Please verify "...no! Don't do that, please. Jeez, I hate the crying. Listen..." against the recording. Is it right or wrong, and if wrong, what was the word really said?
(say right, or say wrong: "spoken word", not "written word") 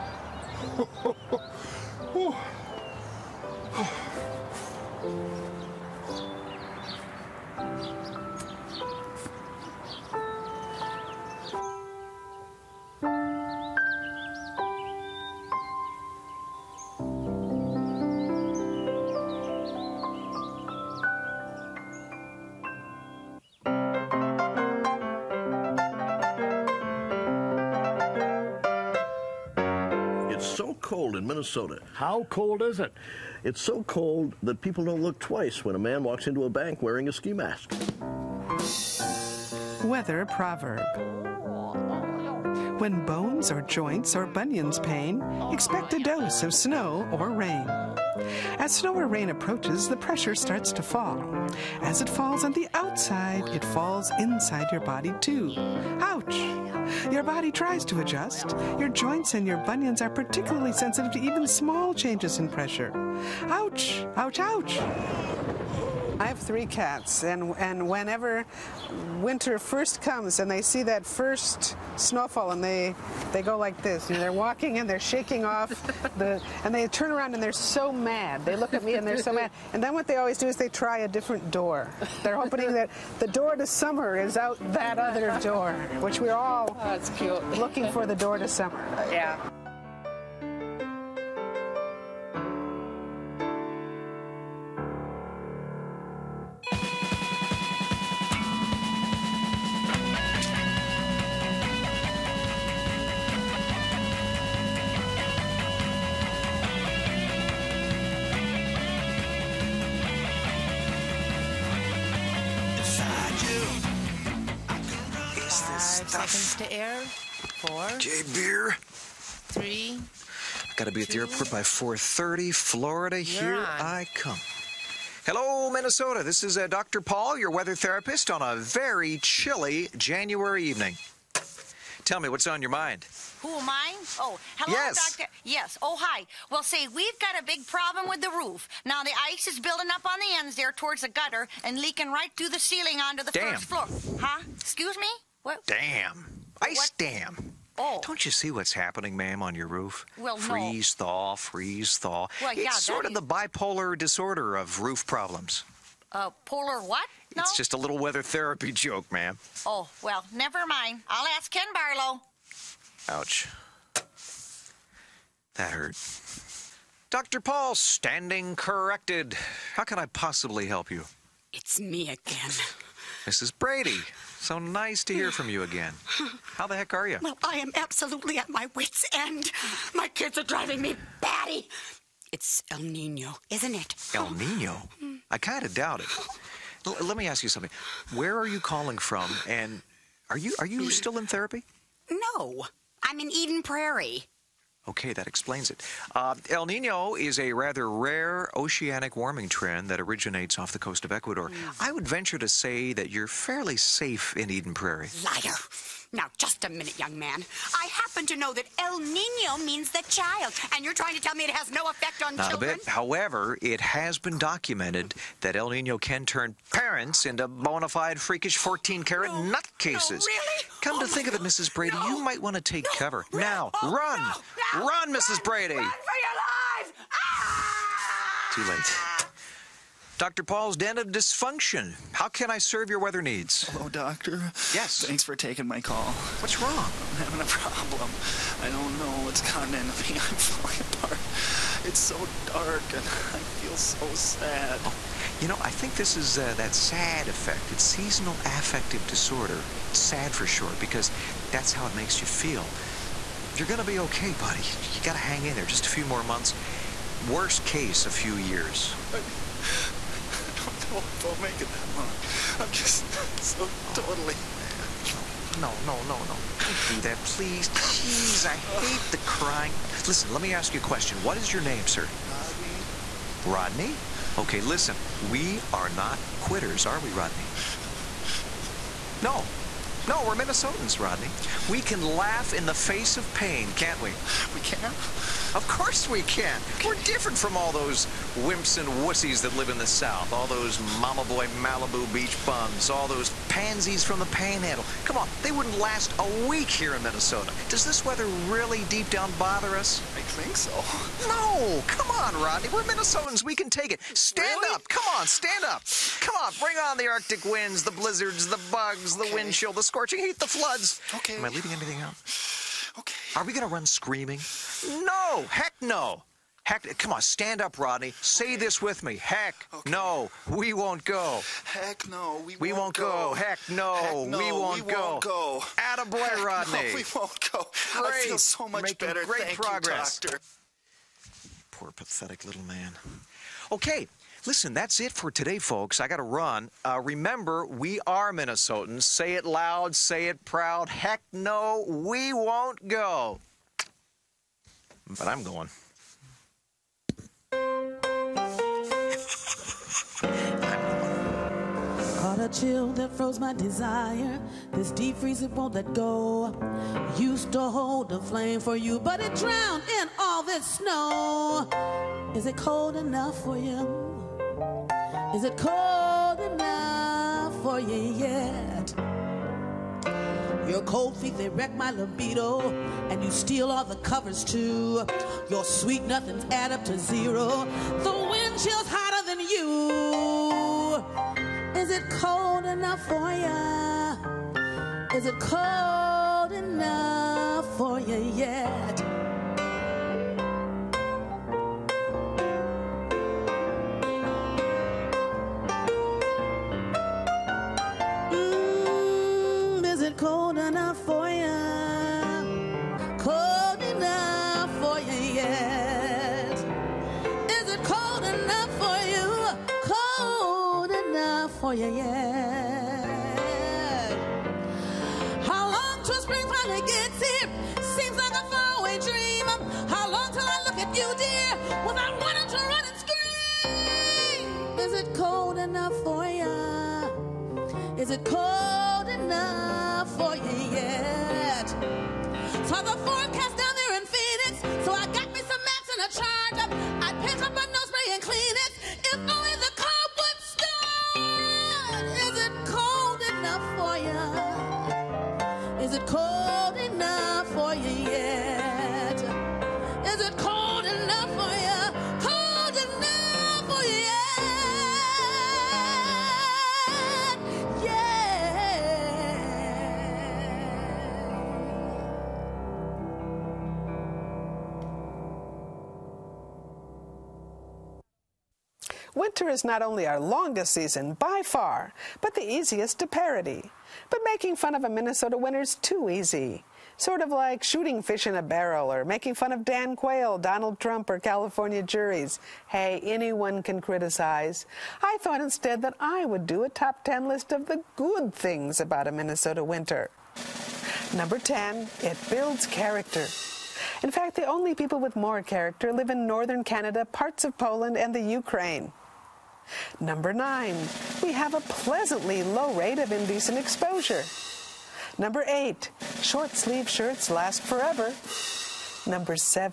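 right.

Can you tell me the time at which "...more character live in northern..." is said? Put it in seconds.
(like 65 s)
495 s.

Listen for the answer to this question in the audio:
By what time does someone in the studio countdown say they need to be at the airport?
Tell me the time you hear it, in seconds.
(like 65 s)
121 s.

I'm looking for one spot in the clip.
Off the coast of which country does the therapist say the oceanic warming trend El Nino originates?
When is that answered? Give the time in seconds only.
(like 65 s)
201 s.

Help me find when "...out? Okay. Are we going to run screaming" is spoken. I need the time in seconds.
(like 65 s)
312 s.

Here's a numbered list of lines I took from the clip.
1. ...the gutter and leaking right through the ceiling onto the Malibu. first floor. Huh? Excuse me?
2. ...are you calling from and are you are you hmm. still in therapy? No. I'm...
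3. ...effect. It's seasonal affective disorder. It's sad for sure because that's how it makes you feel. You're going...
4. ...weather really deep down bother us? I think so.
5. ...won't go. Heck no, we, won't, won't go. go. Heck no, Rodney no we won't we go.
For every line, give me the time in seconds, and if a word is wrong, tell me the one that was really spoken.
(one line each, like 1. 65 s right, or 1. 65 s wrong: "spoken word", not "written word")
1. 141 s wrong: "Damn", not "Malibu"
2. 188 s right
3. 247 s right
4. 298 s right
5. 320 s wrong: "Heck", not "Rodney".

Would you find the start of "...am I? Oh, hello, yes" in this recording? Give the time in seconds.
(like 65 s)
133 s.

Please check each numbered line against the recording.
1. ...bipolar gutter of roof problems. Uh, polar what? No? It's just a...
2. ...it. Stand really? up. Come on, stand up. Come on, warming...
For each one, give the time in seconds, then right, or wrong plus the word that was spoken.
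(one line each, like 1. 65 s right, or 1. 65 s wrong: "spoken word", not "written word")
1. 153 s wrong: "disorder", not "gutter"
2. 303 s wrong: "bring", not "warming".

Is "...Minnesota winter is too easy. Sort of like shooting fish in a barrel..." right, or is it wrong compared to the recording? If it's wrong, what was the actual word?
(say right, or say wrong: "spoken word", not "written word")
right.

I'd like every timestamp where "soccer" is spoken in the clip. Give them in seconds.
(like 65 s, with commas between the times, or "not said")
not said.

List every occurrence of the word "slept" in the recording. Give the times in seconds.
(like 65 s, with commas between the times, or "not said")
not said.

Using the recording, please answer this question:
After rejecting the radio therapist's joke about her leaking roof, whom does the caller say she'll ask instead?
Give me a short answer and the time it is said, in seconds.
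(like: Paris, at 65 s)
Ken Barlow, at 161 s.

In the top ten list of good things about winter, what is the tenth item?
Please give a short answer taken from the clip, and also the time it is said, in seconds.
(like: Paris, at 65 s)
it builds character, at 492 s.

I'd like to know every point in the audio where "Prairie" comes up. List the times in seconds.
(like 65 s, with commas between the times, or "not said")
193 s, 204 s.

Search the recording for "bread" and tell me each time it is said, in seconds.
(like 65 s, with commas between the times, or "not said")
not said.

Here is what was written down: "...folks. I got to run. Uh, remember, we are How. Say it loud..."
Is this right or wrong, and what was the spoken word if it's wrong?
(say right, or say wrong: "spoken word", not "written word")
wrong: "Minnesotans", not "How".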